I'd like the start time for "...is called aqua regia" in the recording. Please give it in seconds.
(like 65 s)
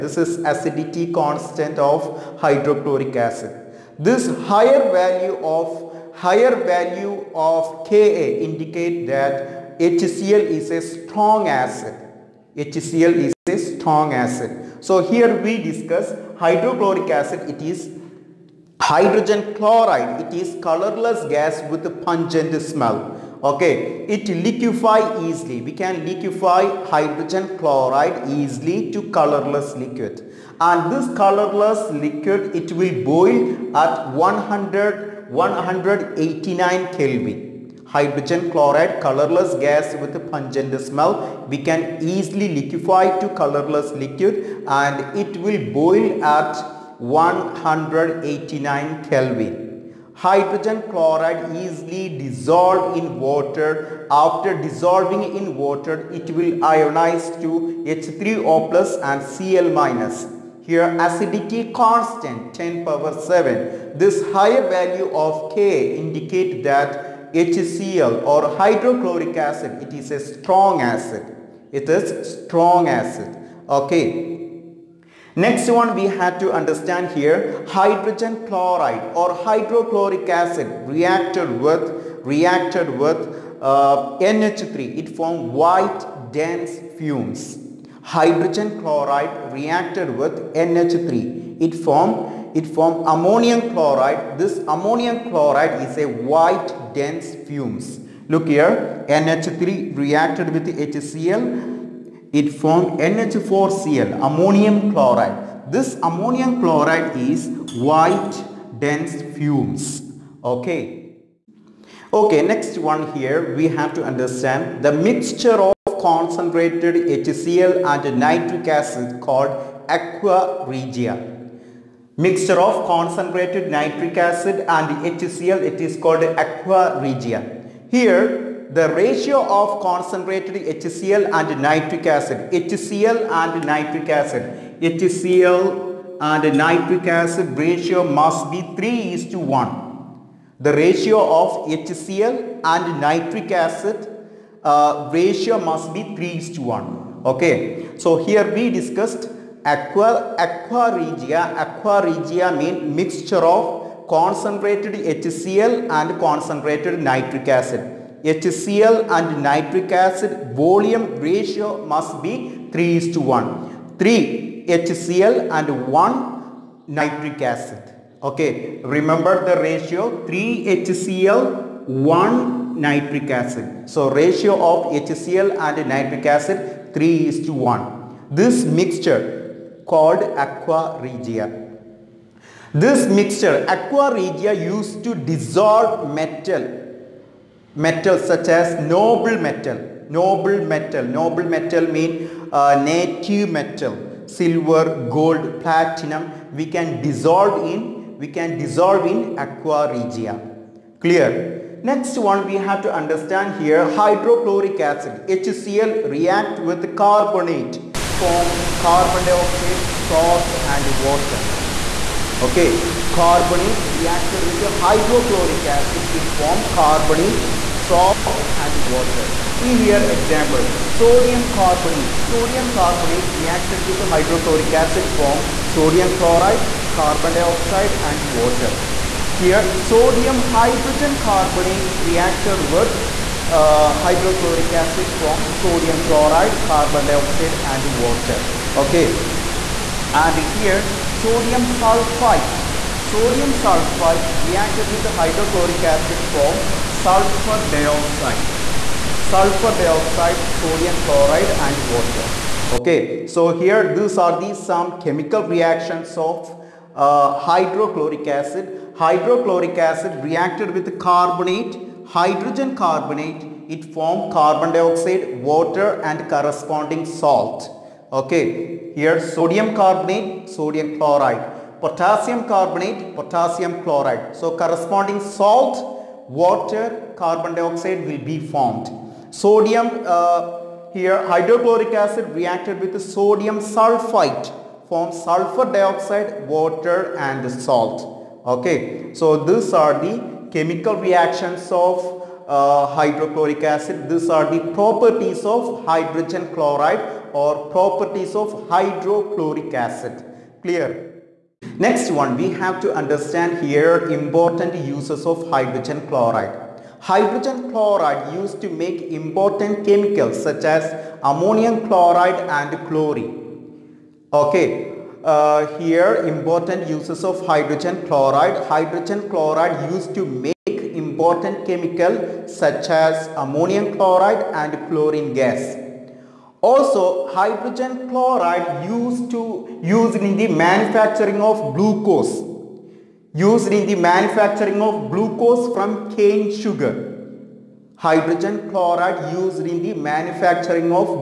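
125 s.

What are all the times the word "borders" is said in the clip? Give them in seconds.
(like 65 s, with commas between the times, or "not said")
not said.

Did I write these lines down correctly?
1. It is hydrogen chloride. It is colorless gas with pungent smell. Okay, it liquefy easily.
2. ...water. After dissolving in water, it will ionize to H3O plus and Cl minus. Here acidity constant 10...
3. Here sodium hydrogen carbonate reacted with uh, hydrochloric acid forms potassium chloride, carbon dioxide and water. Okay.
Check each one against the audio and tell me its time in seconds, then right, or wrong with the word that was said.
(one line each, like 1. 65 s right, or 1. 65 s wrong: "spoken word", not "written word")
1. 17 s right
2. 53 s right
3. 229 s wrong: "sodium", not "potassium".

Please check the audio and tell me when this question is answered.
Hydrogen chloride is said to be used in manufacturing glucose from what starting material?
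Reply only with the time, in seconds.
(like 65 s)
336 s.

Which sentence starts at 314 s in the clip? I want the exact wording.
Okay, uh, here important uses of hydrogen chloride.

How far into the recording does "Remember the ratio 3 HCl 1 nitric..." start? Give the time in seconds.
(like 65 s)
168 s.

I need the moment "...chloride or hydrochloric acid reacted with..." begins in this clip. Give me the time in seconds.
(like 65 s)
78 s.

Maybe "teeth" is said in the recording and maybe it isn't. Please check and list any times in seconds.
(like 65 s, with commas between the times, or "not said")
not said.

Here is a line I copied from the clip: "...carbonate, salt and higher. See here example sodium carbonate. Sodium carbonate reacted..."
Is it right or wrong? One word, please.
wrong.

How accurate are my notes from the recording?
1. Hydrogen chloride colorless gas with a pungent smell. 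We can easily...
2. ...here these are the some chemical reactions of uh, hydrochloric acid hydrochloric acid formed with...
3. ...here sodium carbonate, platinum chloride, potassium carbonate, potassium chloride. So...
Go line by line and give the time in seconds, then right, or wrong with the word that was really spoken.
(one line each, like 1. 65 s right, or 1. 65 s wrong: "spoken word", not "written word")
1. 37 s right
2. 253 s wrong: "reacted", not "formed"
3. 268 s wrong: "sodium", not "platinum".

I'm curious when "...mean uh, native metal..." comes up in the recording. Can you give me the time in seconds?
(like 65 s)
191 s.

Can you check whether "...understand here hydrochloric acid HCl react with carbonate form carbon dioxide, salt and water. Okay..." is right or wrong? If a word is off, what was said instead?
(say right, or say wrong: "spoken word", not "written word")
right.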